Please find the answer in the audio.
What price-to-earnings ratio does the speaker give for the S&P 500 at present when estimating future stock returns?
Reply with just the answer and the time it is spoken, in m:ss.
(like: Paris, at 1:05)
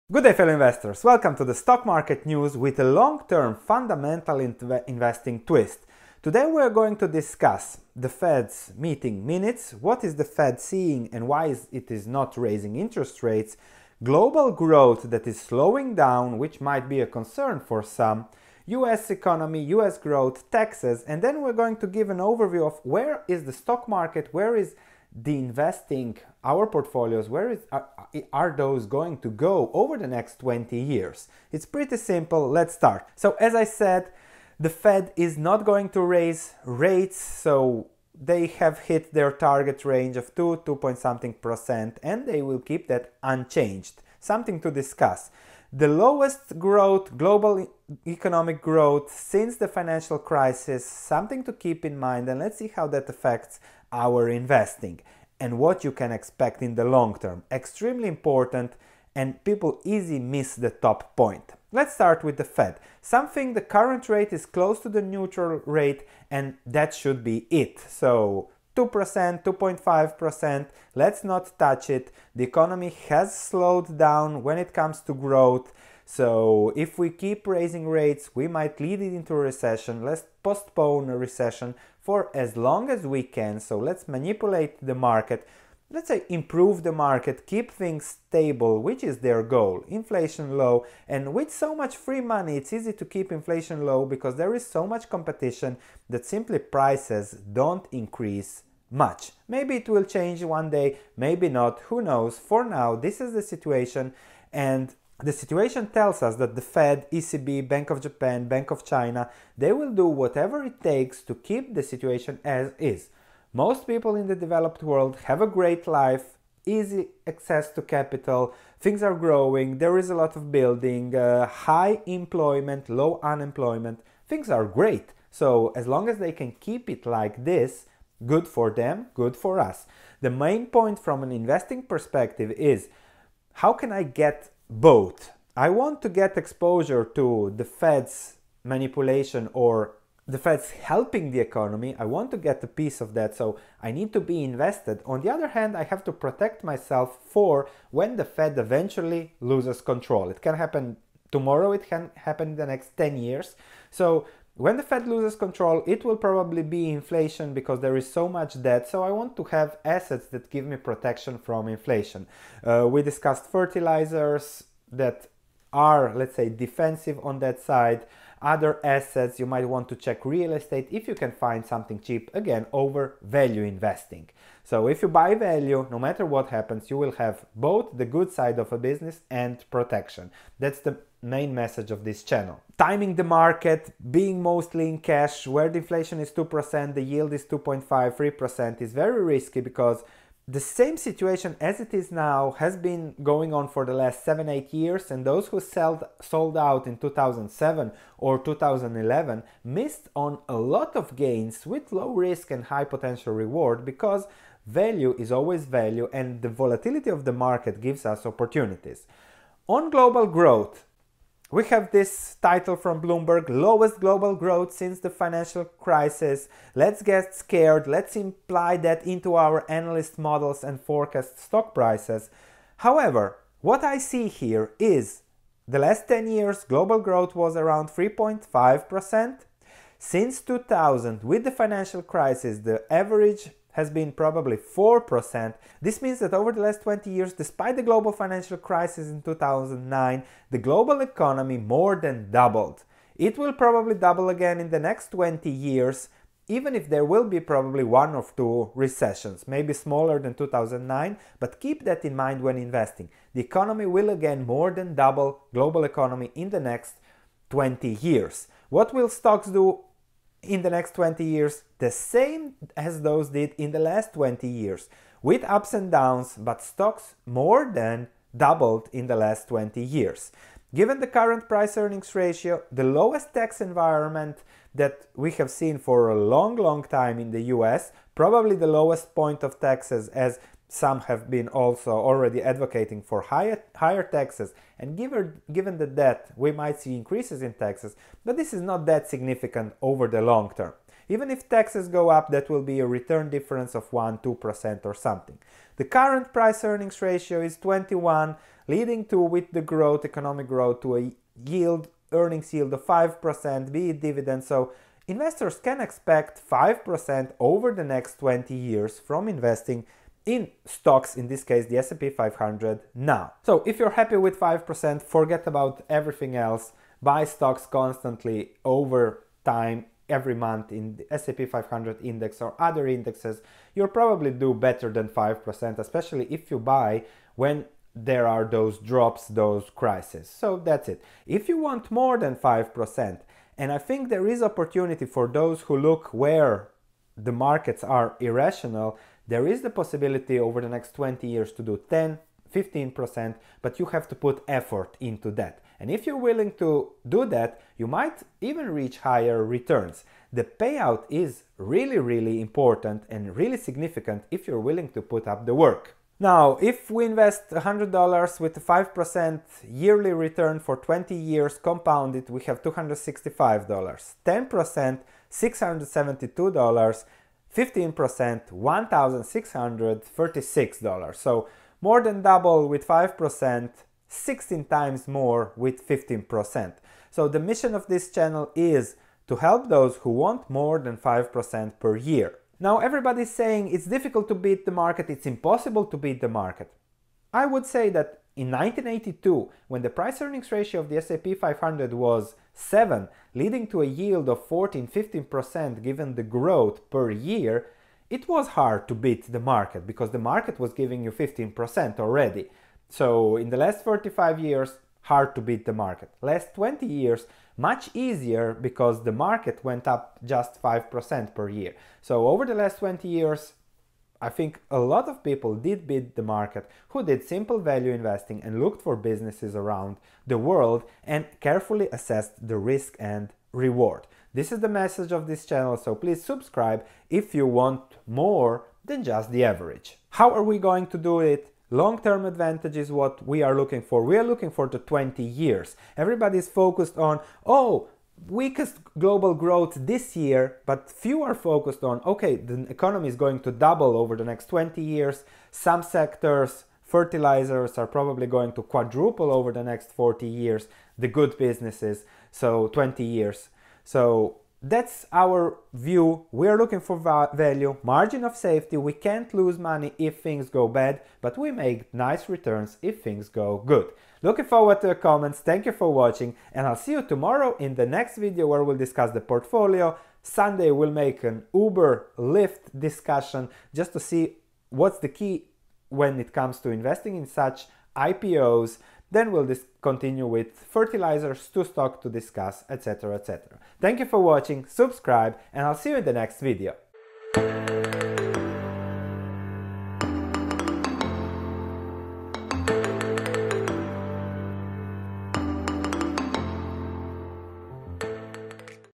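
21, at 4:57.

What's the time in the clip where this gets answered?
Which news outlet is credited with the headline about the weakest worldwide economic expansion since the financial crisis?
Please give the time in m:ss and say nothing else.
3:33.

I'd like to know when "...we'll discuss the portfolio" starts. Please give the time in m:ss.
7:48.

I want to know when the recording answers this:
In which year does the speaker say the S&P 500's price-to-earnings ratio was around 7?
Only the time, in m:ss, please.
6:28.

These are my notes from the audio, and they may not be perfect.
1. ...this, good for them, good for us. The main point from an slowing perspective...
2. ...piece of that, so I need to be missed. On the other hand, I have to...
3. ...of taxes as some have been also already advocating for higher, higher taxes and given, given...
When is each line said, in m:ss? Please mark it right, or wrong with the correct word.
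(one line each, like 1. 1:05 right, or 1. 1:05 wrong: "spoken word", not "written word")
1. 2:07 wrong: "investing", not "slowing"
2. 2:22 wrong: "invested", not "missed"
3. 4:39 right.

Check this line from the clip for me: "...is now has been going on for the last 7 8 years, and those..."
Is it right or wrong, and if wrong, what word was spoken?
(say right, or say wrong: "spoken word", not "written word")
right.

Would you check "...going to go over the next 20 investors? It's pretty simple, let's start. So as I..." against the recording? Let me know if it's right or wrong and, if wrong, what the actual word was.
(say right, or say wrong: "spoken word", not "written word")
wrong: "years", not "investors".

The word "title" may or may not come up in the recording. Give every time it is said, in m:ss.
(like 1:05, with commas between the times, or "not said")
3:32.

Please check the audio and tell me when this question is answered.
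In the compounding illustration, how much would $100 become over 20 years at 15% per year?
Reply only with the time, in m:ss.
6:08.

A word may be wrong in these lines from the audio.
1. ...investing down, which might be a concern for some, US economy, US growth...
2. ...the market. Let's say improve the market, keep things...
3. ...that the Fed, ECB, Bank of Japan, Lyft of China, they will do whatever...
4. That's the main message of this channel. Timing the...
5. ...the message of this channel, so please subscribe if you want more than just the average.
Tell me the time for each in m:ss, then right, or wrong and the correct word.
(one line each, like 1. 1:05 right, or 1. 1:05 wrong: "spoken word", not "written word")
1. 0:15 wrong: "slowing", not "investing"
2. 1:24 right
3. 1:46 wrong: "Bank", not "Lyft"
4. 3:00 right
5. 7:04 right.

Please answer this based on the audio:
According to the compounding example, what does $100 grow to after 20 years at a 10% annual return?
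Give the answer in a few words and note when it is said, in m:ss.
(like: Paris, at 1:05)
$672, at 6:05.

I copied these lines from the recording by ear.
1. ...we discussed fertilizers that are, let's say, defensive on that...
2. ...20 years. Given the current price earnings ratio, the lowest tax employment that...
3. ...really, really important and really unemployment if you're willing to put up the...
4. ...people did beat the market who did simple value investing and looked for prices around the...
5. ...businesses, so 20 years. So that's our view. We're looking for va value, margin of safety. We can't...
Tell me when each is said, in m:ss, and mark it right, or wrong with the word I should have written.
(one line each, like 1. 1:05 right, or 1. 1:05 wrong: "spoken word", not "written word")
1. 2:42 right
2. 4:29 wrong: "environment", not "employment"
3. 5:51 wrong: "significant", not "unemployment"
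4. 6:55 wrong: "businesses", not "prices"
5. 7:31 right.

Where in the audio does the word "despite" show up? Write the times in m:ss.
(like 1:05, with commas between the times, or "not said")
3:57.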